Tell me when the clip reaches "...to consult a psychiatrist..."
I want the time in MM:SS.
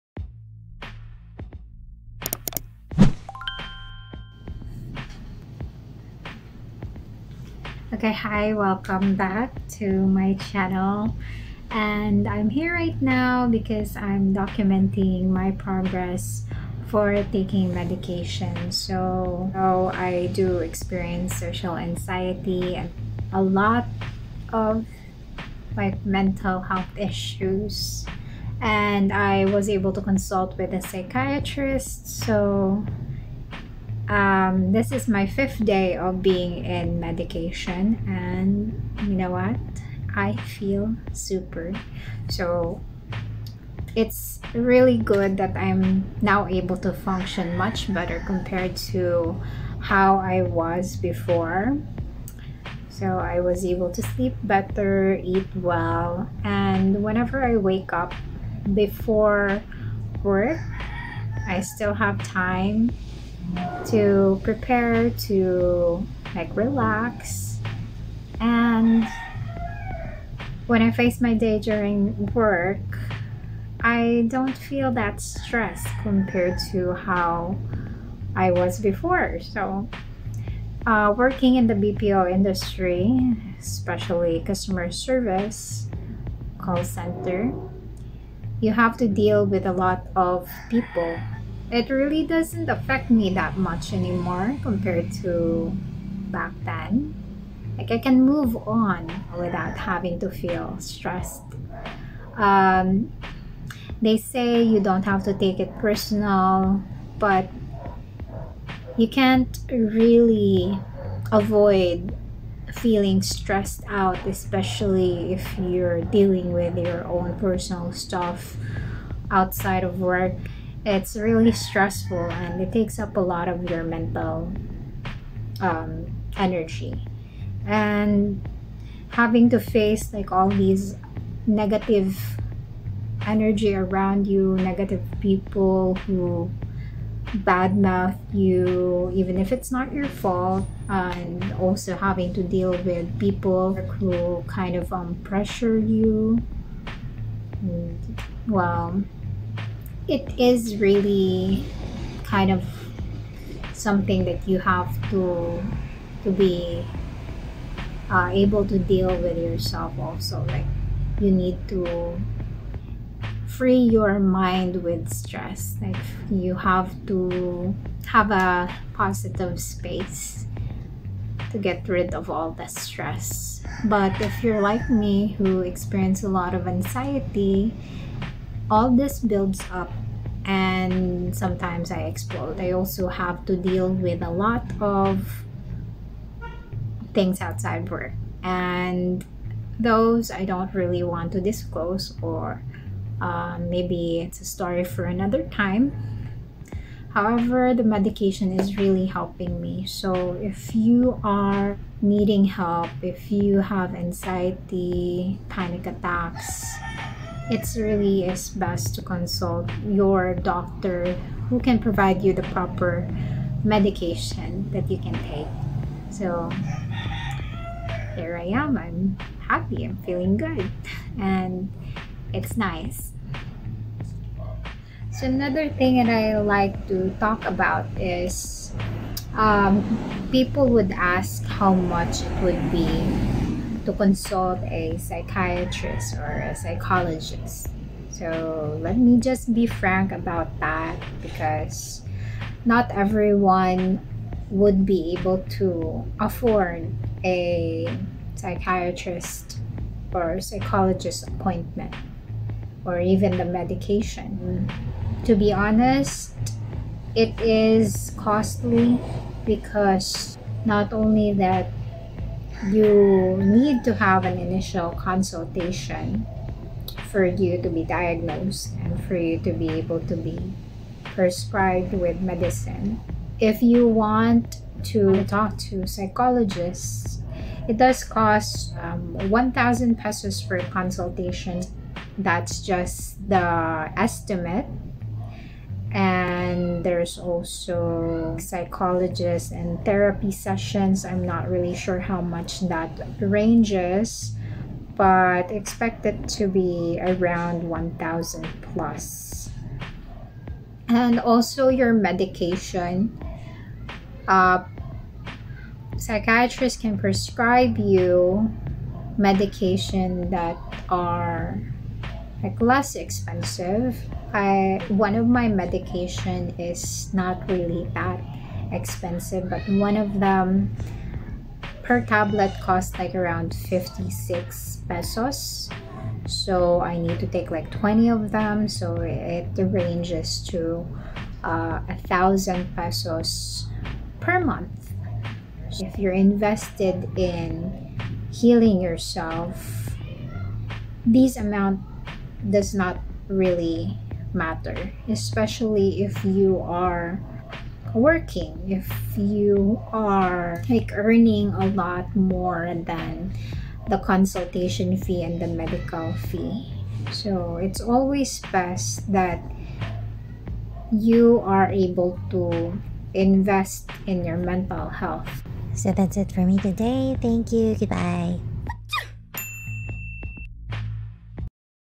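03:53.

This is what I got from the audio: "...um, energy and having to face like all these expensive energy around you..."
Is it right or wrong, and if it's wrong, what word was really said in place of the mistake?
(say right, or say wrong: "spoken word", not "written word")
wrong: "negative", not "expensive".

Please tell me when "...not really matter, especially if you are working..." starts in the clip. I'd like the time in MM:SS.
05:42.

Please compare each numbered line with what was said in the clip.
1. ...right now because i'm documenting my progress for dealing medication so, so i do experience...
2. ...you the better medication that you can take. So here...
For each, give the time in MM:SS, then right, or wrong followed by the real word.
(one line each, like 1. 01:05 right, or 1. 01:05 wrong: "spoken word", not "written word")
1. 00:12 wrong: "taking", not "dealing"
2. 03:32 wrong: "proper", not "better".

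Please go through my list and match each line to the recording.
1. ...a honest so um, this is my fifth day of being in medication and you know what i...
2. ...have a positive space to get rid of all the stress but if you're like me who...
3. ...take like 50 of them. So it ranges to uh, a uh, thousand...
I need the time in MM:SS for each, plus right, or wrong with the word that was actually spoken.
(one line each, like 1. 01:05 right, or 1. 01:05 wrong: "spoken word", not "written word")
1. 00:30 wrong: "psychiatrist", not "honest"
2. 02:48 right
3. 05:27 wrong: "20", not "50".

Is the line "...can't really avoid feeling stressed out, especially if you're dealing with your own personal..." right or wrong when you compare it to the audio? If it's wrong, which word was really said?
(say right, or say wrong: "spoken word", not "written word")
right.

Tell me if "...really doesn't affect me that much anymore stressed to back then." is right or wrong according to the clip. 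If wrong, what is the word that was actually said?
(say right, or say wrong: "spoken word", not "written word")
wrong: "compared", not "stressed".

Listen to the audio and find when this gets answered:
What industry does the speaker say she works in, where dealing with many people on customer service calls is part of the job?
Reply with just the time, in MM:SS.
01:21.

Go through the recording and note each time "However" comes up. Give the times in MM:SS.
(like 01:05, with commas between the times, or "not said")
03:17.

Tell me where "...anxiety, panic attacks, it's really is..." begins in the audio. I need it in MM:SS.
03:23.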